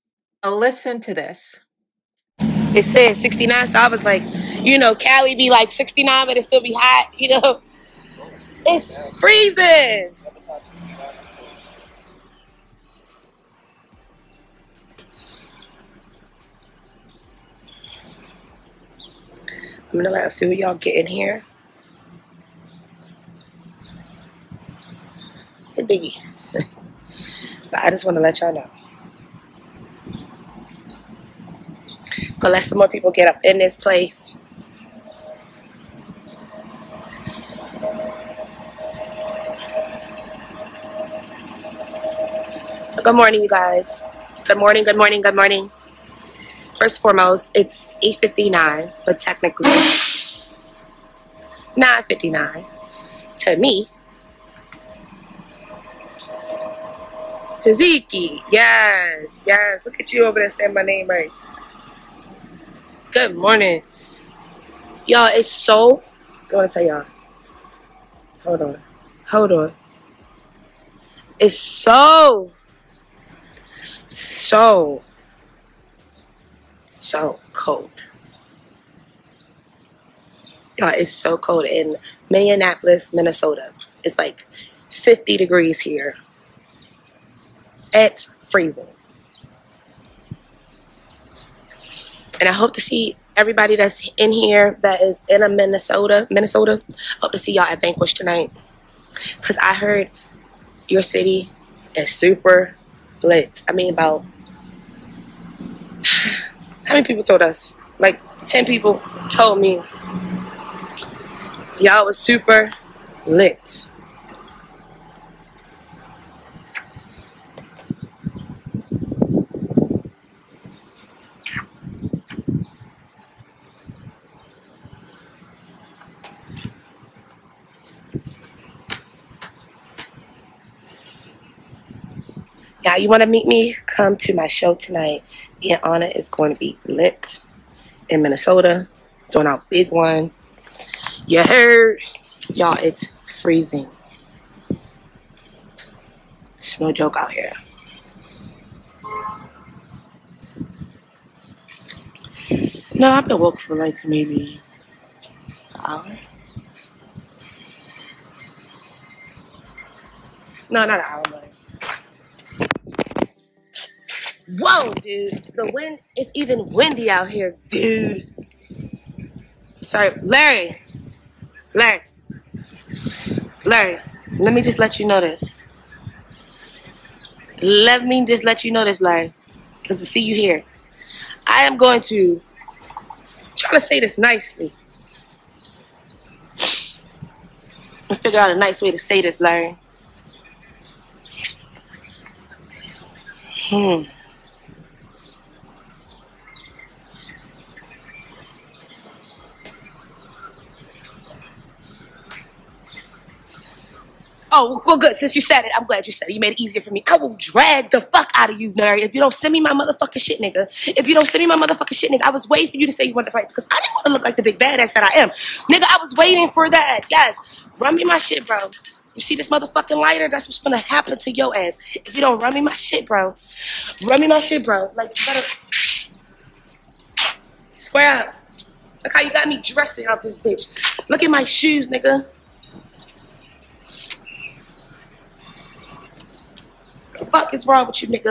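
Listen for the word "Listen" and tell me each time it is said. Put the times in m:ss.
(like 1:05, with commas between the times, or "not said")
0:00.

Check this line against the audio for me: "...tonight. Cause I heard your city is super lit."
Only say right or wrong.
right.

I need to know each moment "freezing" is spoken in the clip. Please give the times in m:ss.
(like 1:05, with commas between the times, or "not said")
0:09, 1:28, 2:23.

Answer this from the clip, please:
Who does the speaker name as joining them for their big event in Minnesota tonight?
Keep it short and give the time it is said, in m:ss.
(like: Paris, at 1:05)
Anna, at 2:15.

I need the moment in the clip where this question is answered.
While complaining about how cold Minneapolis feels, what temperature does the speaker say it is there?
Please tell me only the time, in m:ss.
1:24.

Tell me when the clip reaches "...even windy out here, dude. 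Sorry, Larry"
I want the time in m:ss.
2:46.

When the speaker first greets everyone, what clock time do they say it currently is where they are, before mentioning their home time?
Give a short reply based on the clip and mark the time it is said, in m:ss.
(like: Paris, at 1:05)
8:59, at 0:48.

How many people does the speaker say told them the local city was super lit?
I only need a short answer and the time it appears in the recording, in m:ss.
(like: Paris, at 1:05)
10, at 1:48.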